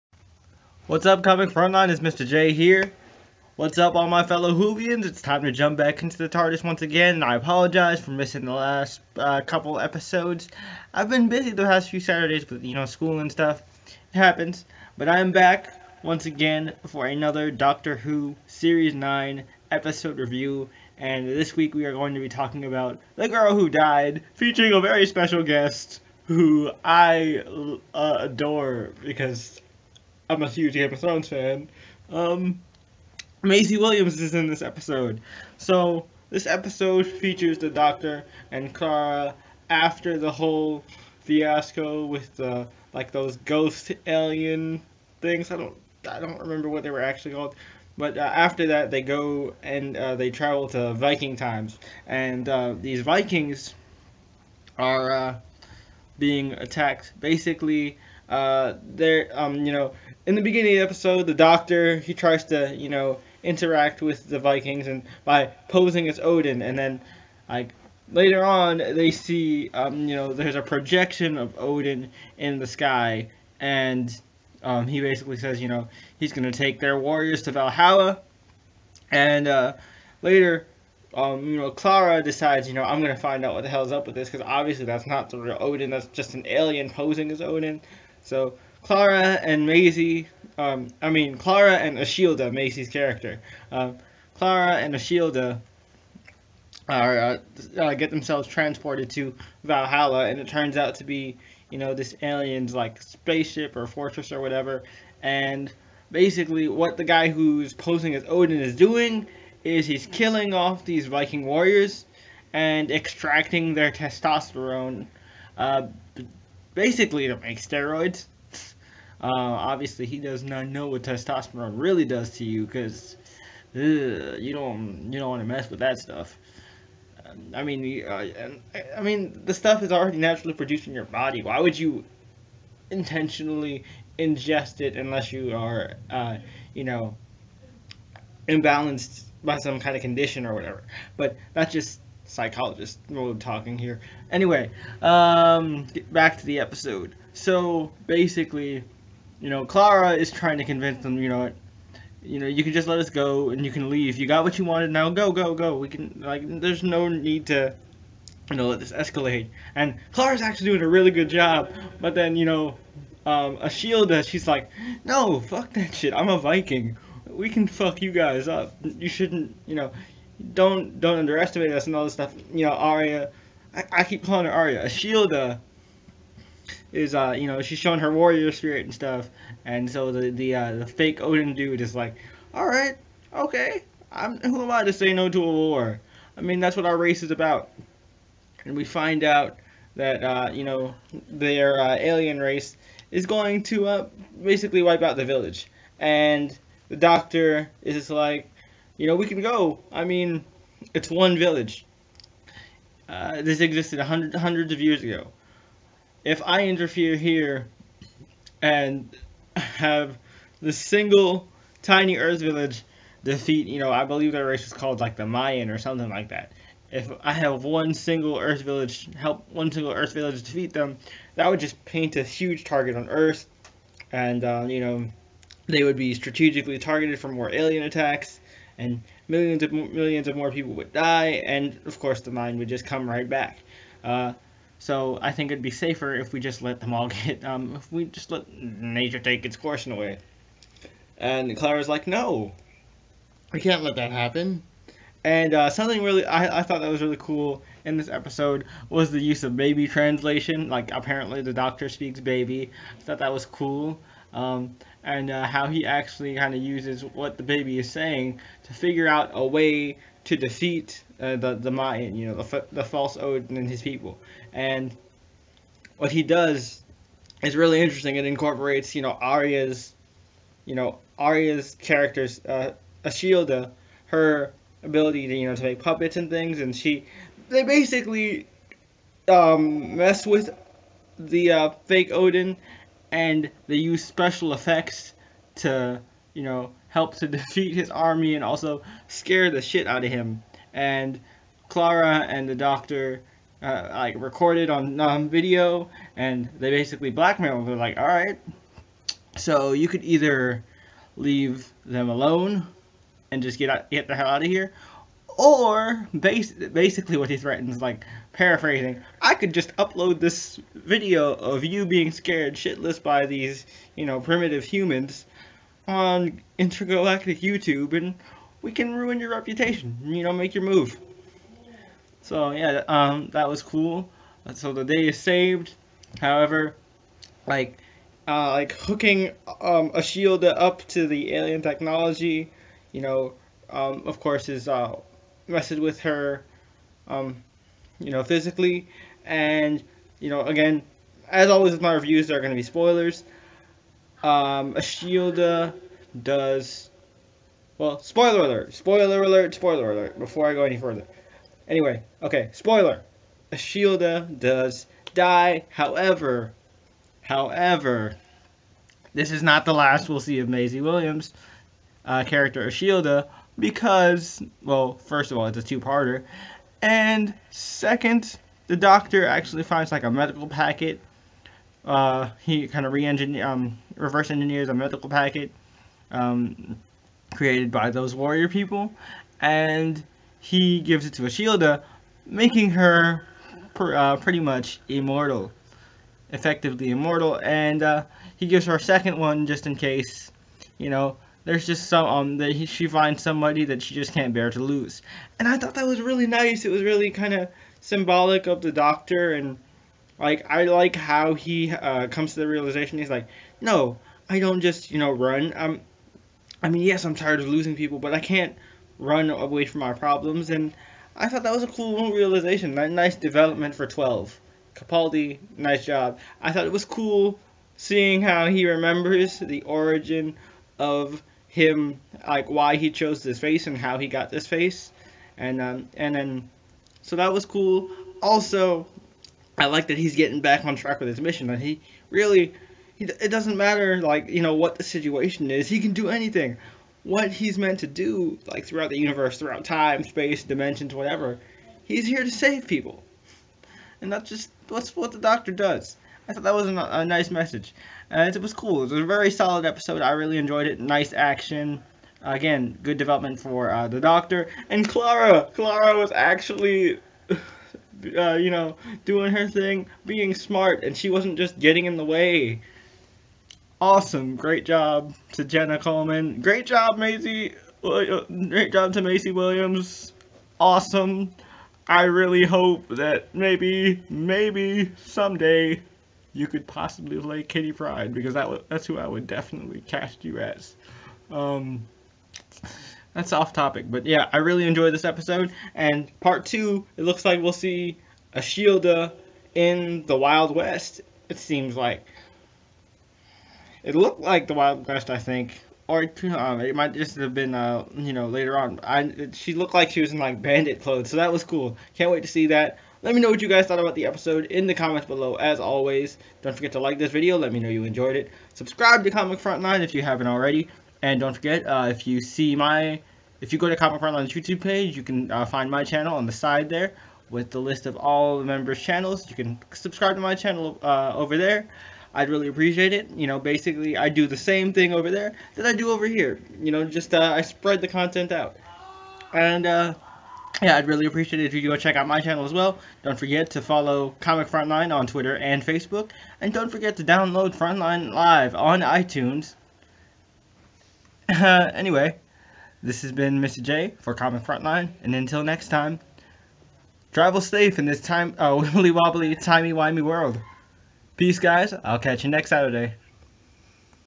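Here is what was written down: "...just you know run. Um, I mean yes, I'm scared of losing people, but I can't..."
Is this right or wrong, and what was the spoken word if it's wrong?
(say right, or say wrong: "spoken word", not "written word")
wrong: "tired", not "scared".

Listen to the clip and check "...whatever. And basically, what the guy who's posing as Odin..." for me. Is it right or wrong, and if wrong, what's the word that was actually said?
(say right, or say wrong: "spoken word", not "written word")
right.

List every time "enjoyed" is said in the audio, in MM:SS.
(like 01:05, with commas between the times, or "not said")
07:30, 08:04, 08:27.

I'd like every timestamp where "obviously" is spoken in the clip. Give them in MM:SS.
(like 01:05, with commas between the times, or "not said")
01:24, 01:59.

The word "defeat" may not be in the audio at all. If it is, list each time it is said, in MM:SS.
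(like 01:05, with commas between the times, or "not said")
03:33, 03:40, 04:20, 04:47.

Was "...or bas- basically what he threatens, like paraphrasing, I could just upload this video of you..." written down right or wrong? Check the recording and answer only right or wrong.
right.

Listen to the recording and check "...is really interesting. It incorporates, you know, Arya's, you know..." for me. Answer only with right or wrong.
right.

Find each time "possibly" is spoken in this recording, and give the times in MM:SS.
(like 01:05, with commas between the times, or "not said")
07:56.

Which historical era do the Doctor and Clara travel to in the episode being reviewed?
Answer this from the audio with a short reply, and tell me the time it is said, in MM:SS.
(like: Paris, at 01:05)
Viking times, at 00:50.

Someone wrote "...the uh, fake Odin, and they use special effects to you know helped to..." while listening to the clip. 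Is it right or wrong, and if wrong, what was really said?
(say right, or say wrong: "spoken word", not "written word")
right.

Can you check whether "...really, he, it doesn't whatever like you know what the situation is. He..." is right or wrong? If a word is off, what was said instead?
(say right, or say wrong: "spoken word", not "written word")
wrong: "matter", not "whatever".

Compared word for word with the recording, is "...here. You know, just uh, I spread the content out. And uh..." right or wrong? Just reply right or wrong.
right.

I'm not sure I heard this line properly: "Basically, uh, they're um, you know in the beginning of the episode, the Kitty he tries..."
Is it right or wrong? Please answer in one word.
wrong.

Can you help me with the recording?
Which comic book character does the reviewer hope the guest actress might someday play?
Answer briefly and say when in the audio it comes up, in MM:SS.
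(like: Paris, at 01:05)
Kitty Pryde, at 07:57.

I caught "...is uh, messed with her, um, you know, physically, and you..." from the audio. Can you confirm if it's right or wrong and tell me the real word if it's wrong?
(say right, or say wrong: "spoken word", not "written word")
right.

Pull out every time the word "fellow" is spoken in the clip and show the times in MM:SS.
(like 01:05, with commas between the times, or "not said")
00:04.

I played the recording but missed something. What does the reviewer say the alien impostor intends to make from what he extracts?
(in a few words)
steroids.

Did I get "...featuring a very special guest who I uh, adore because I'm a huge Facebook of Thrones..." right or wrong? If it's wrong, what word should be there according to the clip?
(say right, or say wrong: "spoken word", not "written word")
wrong: "Game", not "Facebook".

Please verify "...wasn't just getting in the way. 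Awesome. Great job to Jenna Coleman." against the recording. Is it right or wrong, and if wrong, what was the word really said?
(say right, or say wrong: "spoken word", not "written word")
right.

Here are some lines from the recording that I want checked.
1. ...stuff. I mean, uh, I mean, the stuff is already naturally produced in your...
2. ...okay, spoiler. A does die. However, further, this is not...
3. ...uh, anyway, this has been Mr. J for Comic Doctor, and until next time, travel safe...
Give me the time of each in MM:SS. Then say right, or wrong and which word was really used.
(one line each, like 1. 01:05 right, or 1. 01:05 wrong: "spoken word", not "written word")
1. 02:05 right
2. 05:52 wrong: "however", not "further"
3. 09:01 wrong: "Frontline", not "Doctor".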